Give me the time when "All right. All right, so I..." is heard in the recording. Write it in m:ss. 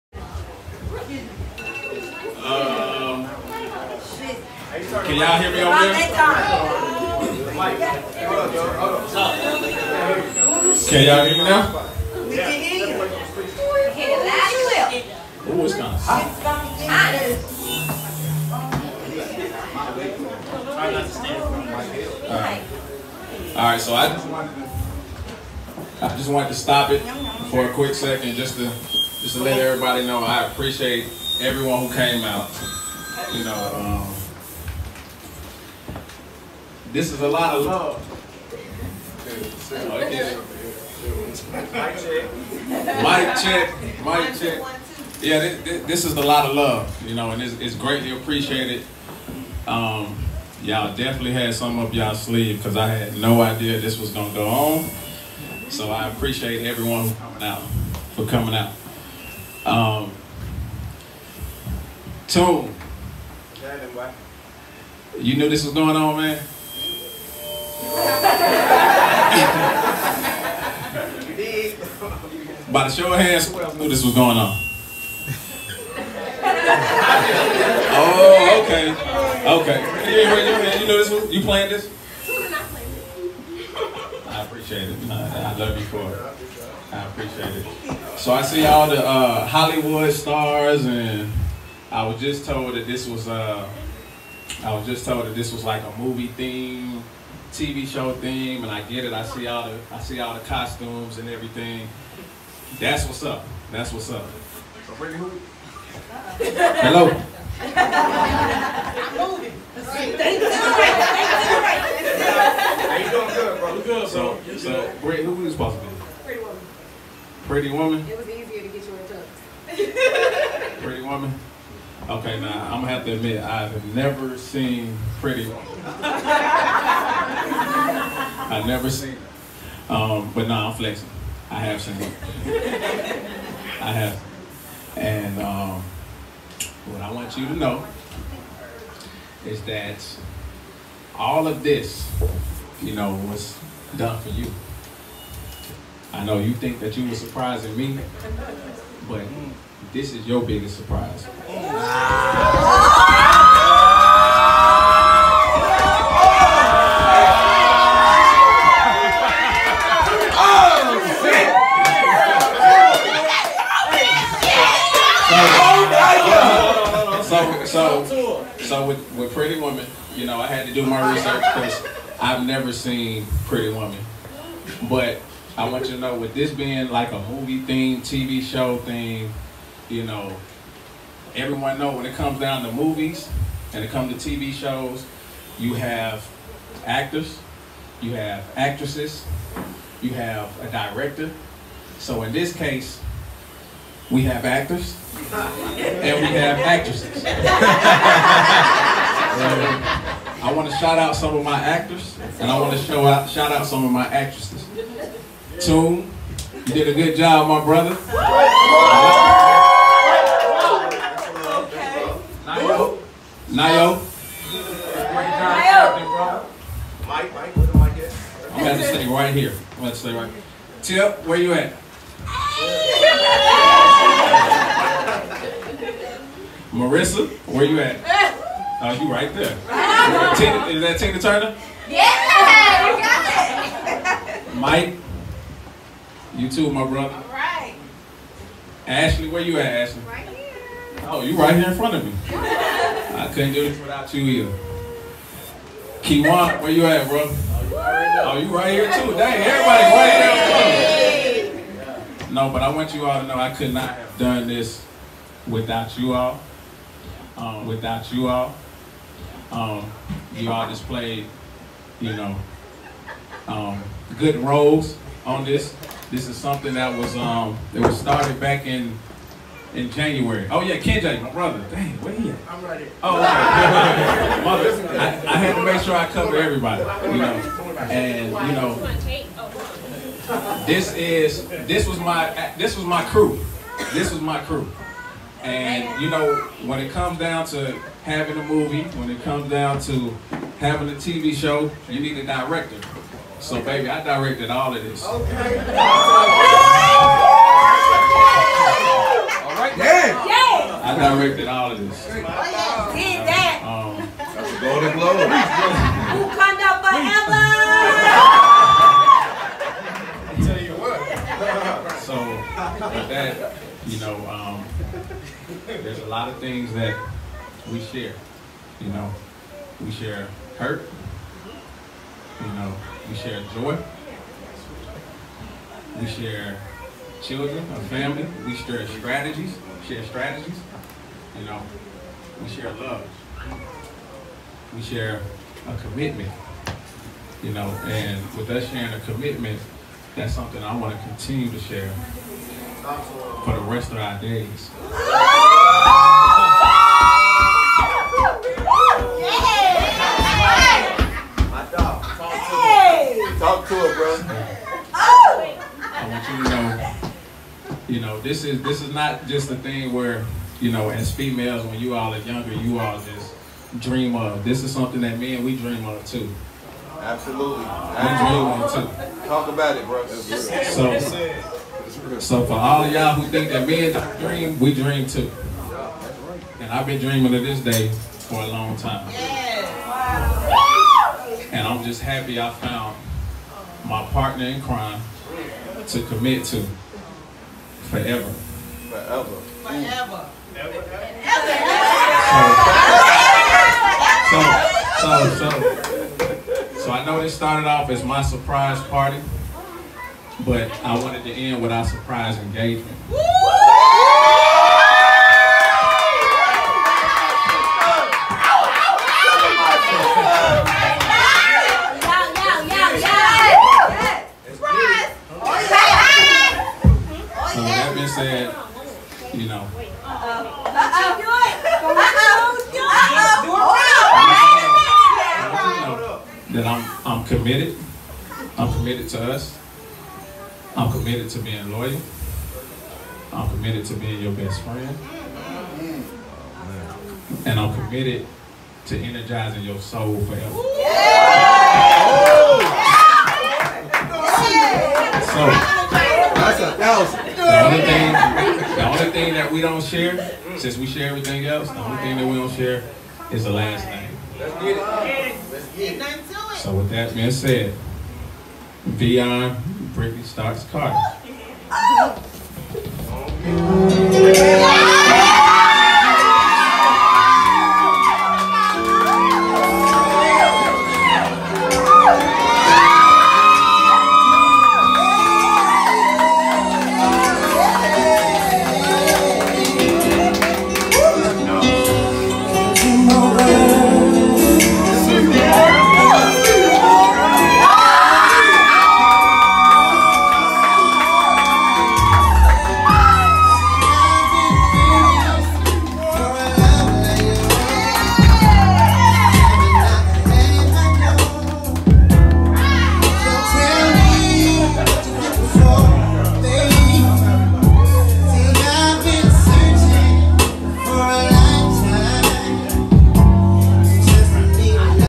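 0:22.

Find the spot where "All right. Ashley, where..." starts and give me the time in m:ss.
3:57.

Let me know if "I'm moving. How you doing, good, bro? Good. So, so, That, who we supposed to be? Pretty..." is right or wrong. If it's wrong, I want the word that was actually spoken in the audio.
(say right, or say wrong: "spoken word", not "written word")
wrong: "Brady", not "That".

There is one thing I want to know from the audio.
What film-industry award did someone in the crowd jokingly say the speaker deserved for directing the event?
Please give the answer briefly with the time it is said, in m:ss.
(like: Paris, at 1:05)
Golden Globe, at 5:04.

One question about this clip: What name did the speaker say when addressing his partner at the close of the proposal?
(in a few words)
Britne Stocks Carter.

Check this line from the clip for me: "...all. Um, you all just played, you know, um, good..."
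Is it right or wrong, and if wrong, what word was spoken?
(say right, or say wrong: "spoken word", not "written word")
right.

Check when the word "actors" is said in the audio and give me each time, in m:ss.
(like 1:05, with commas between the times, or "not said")
3:06, 3:14, 3:21.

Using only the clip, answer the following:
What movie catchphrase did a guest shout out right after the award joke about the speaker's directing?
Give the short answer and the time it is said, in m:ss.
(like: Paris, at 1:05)
Wakanda forever, at 5:06.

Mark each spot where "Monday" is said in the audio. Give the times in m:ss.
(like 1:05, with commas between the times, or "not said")
not said.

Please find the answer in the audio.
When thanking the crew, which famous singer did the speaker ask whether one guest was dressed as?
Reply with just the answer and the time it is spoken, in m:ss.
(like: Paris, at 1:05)
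Tina Turner, at 3:50.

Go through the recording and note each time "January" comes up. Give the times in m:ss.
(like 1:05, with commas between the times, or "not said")
4:29.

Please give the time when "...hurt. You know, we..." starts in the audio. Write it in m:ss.
5:20.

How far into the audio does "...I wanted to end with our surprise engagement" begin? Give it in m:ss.
6:40.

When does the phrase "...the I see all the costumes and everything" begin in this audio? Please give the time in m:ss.
1:39.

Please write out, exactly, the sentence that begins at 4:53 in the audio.
So, baby, I directed all of this.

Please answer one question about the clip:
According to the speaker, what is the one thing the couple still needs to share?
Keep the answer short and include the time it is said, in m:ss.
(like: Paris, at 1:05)
The last name, at 7:33.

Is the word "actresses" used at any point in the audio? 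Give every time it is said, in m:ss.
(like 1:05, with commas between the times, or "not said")
3:08, 3:16, 3:24.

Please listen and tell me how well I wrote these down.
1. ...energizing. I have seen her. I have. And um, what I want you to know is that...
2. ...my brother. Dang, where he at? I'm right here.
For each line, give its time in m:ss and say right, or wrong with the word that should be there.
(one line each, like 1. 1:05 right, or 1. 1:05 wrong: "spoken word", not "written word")
1. 2:10 wrong: "flexing", not "energizing"
2. 4:31 right.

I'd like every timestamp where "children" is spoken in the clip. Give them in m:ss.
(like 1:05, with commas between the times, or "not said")
5:27.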